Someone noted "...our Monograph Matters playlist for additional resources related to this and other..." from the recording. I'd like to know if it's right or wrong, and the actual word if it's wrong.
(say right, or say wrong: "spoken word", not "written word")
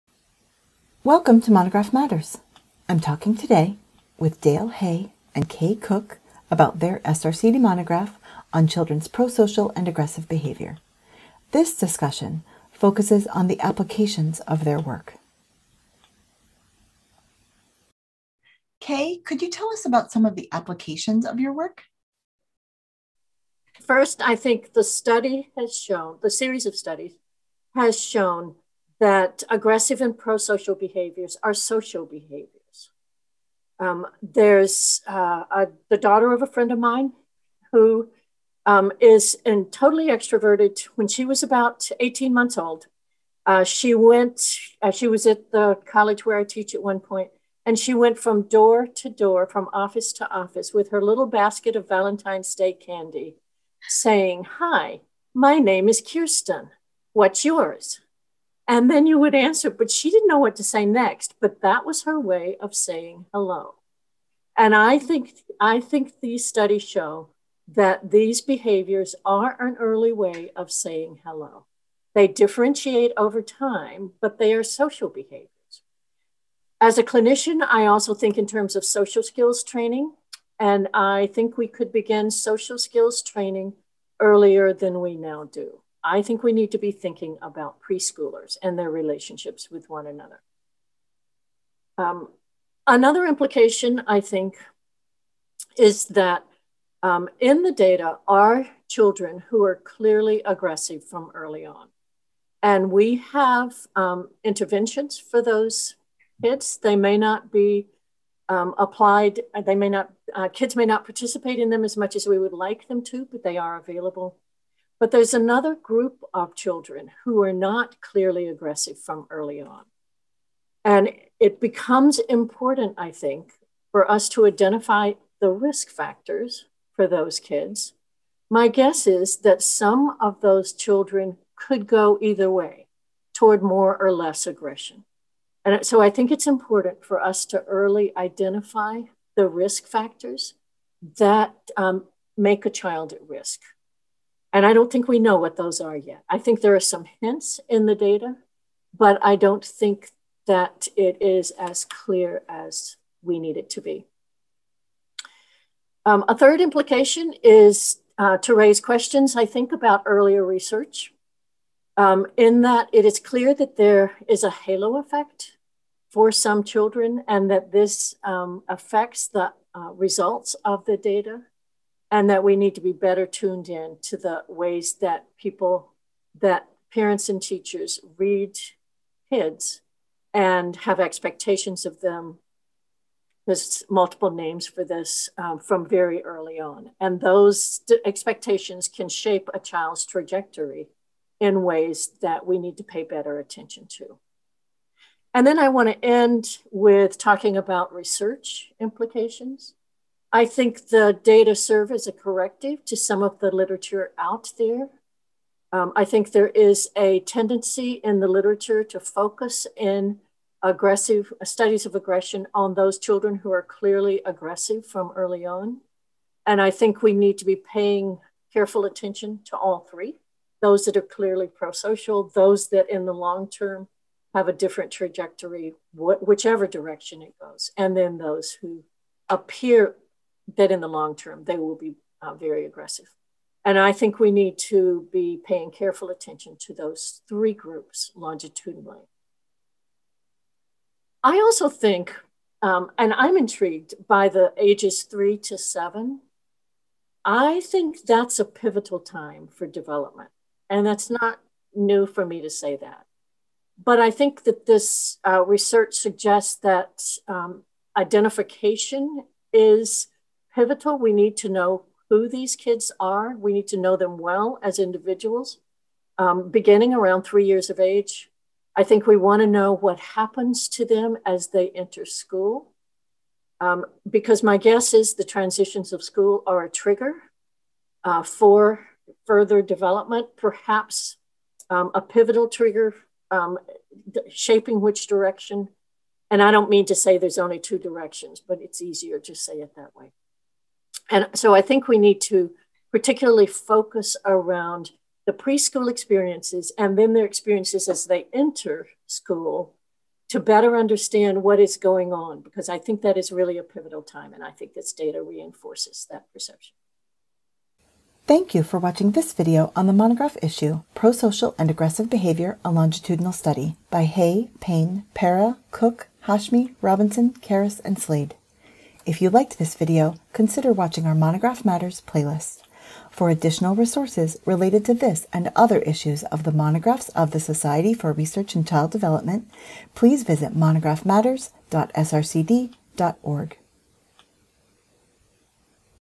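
right.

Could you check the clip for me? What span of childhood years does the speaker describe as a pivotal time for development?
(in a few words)
3 to 7.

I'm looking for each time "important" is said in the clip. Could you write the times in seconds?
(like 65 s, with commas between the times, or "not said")
122 s, 136 s.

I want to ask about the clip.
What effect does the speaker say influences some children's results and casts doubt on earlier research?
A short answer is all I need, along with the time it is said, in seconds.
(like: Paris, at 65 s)
Halo effect, at 164 s.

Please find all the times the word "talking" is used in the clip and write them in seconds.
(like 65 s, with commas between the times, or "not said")
2 s, 197 s.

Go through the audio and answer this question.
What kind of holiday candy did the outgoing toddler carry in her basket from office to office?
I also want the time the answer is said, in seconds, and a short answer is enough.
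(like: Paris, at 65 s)
Valentine's Day candy, at 51 s.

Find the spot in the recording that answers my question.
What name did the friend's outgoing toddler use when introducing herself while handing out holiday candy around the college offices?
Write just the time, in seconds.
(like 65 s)
56 s.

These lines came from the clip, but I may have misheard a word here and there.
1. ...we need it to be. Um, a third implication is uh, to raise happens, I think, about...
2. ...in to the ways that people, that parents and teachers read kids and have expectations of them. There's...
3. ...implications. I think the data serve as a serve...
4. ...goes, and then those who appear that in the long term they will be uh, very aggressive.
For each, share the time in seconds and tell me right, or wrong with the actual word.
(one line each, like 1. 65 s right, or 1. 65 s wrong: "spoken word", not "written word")
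1. 153 s wrong: "questions", not "happens"
2. 173 s right
3. 198 s wrong: "corrective", not "serve"
4. 227 s right.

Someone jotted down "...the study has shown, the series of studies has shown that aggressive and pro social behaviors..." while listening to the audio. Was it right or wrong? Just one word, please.
right.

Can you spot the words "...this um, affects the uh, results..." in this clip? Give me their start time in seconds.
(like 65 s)
167 s.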